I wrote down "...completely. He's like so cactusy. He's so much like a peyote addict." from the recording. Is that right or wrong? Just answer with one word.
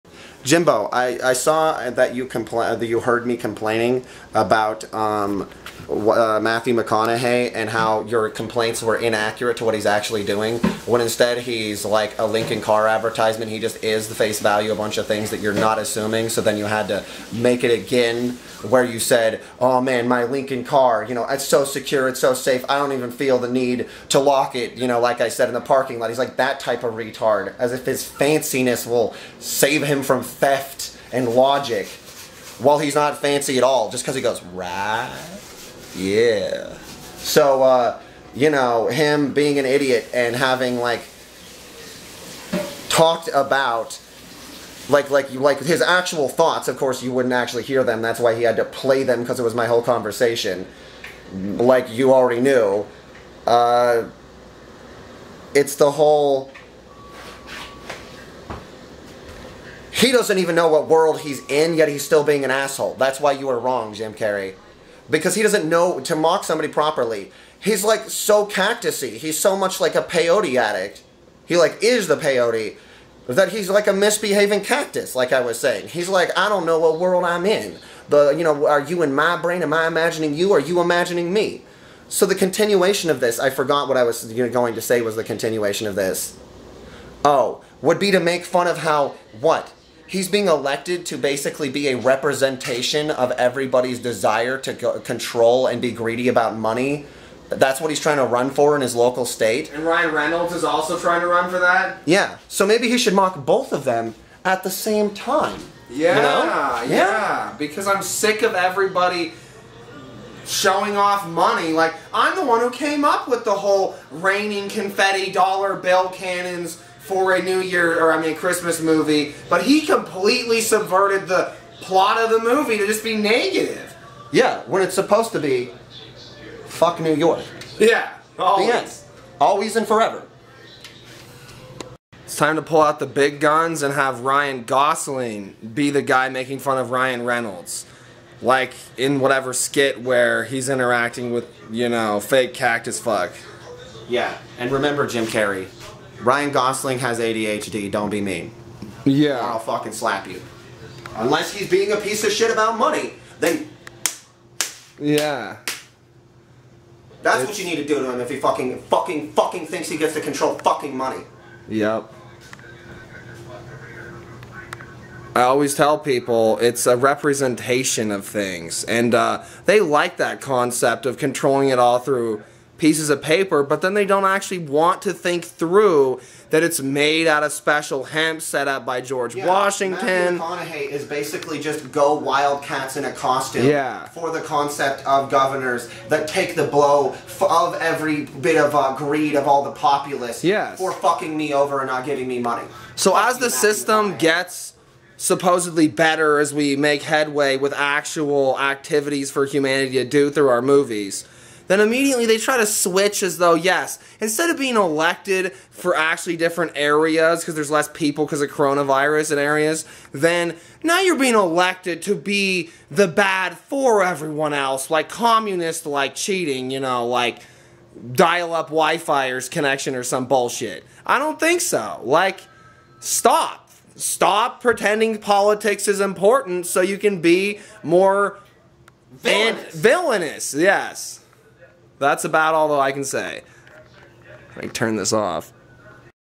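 wrong.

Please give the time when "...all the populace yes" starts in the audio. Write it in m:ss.
3:09.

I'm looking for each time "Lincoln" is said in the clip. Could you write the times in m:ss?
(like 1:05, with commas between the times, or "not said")
0:12, 0:20.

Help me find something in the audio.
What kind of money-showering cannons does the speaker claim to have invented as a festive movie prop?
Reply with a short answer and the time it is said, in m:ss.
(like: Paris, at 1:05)
confetti dollar bill cannons, at 1:54.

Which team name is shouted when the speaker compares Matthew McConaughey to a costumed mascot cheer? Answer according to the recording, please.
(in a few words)
wildcats.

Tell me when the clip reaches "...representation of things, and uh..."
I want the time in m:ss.
2:46.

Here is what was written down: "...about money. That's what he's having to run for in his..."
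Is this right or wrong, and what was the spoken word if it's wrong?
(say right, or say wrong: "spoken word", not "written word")
wrong: "trying", not "having".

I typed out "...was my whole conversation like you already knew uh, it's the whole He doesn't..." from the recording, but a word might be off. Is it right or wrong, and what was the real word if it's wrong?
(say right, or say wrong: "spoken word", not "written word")
right.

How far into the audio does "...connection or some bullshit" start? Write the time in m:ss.
3:39.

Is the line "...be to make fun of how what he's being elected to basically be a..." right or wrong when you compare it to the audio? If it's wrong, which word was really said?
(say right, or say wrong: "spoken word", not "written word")
right.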